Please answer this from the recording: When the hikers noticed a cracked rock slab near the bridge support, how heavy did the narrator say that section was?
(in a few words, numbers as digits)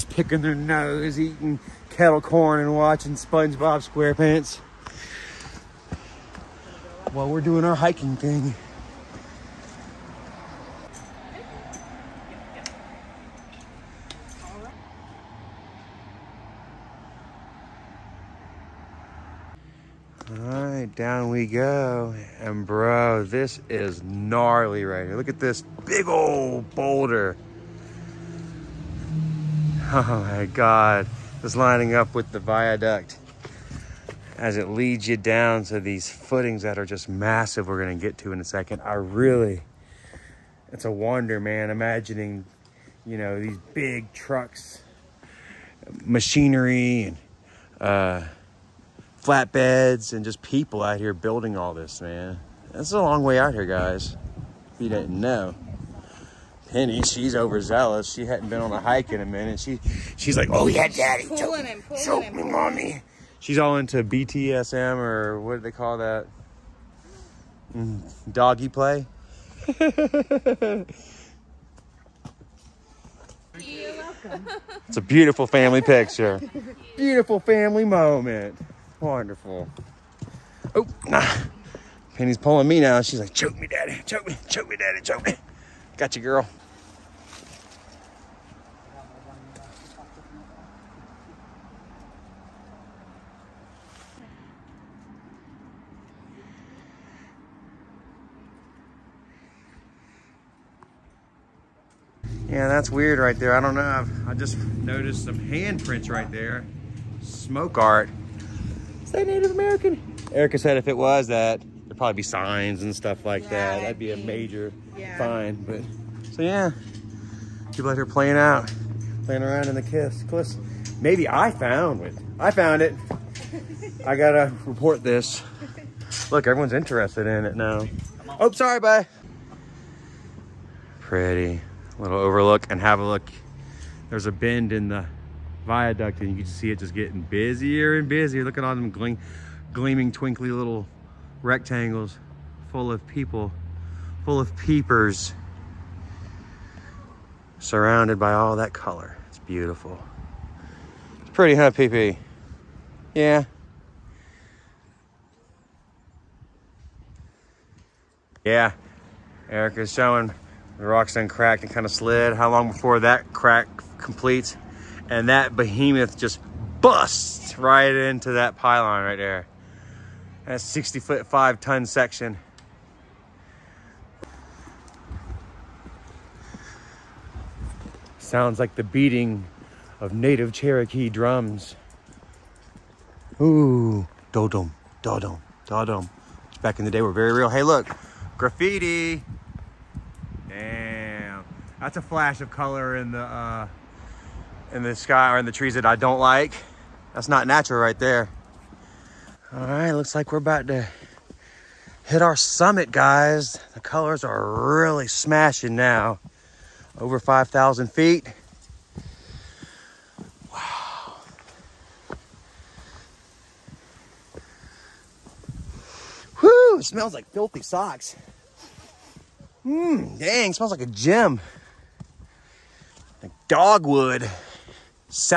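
5 ton.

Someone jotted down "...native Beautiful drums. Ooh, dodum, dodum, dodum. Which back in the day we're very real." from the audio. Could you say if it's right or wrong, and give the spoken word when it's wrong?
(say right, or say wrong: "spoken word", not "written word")
wrong: "Cherokee", not "Beautiful".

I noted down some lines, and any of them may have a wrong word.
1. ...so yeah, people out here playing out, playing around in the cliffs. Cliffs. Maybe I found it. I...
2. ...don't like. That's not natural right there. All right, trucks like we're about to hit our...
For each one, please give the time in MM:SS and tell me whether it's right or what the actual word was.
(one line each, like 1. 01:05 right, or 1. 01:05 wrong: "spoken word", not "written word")
1. 01:56 right
2. 03:15 wrong: "looks", not "trucks".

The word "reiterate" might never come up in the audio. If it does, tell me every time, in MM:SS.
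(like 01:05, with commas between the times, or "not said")
not said.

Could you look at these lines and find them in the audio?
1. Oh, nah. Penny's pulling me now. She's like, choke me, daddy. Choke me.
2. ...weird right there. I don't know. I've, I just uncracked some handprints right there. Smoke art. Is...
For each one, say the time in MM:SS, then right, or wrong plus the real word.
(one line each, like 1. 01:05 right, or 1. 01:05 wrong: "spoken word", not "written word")
1. 01:20 right
2. 01:42 wrong: "noticed", not "uncracked".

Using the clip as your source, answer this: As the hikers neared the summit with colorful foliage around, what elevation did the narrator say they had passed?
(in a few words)
5,000 feet.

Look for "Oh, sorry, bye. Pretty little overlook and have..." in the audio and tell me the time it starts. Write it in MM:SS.
02:08.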